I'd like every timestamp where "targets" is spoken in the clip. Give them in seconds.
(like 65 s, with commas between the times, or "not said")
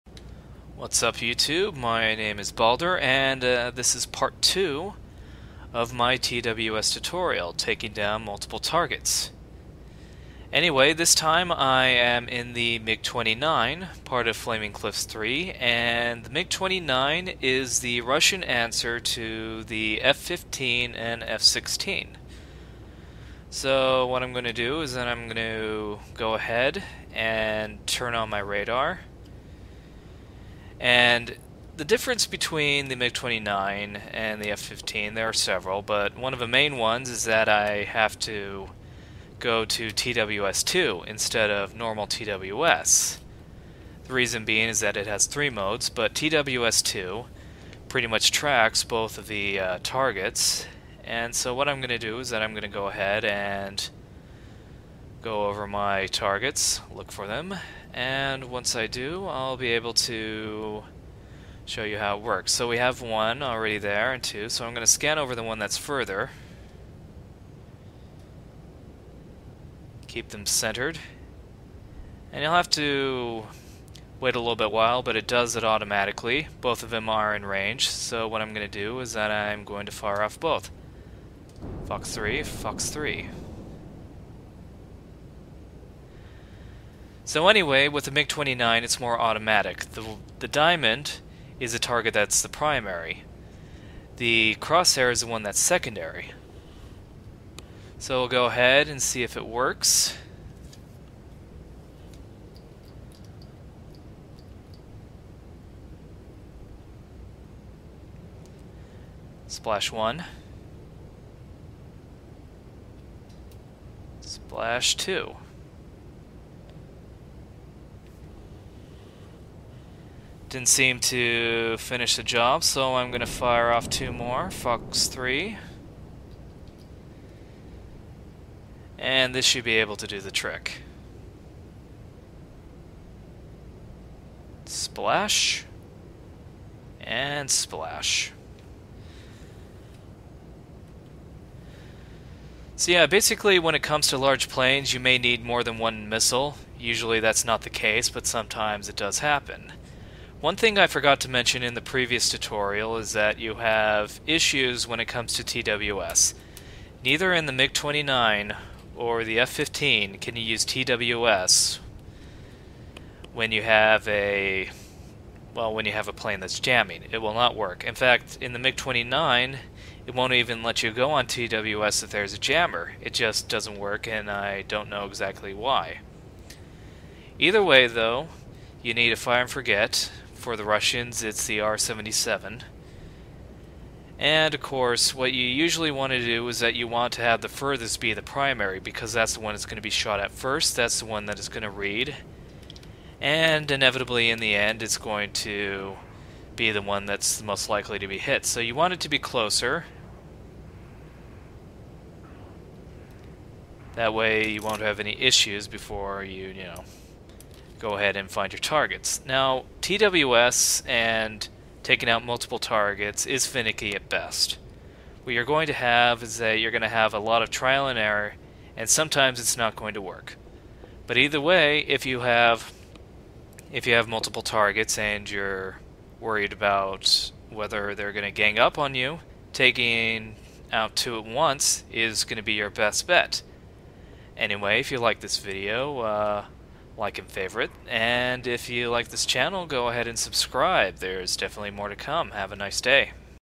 8 s, 49 s, 56 s, 91 s, 208 s, 212 s, 224 s.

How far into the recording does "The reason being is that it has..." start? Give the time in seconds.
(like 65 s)
44 s.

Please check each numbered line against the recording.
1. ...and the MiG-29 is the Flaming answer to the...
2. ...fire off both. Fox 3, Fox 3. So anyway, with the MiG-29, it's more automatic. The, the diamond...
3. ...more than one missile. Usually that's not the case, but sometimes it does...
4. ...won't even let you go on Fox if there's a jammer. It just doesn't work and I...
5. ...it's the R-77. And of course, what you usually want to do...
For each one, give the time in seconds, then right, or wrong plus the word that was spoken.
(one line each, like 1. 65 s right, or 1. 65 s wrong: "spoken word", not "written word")
1. 15 s wrong: "Russian", not "Flaming"
2. 79 s right
3. 145 s right
4. 170 s wrong: "TWS", not "Fox"
5. 181 s right.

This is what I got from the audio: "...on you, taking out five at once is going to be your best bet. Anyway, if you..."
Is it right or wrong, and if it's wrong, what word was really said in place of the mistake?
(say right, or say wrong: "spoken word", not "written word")
wrong: "two", not "five".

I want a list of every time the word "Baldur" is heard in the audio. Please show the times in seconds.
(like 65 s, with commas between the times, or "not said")
2 s.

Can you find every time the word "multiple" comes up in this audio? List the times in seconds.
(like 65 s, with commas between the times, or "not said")
8 s, 212 s, 224 s.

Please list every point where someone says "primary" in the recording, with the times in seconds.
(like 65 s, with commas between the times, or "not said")
92 s, 188 s.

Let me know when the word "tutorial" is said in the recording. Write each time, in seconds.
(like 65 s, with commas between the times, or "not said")
6 s, 152 s.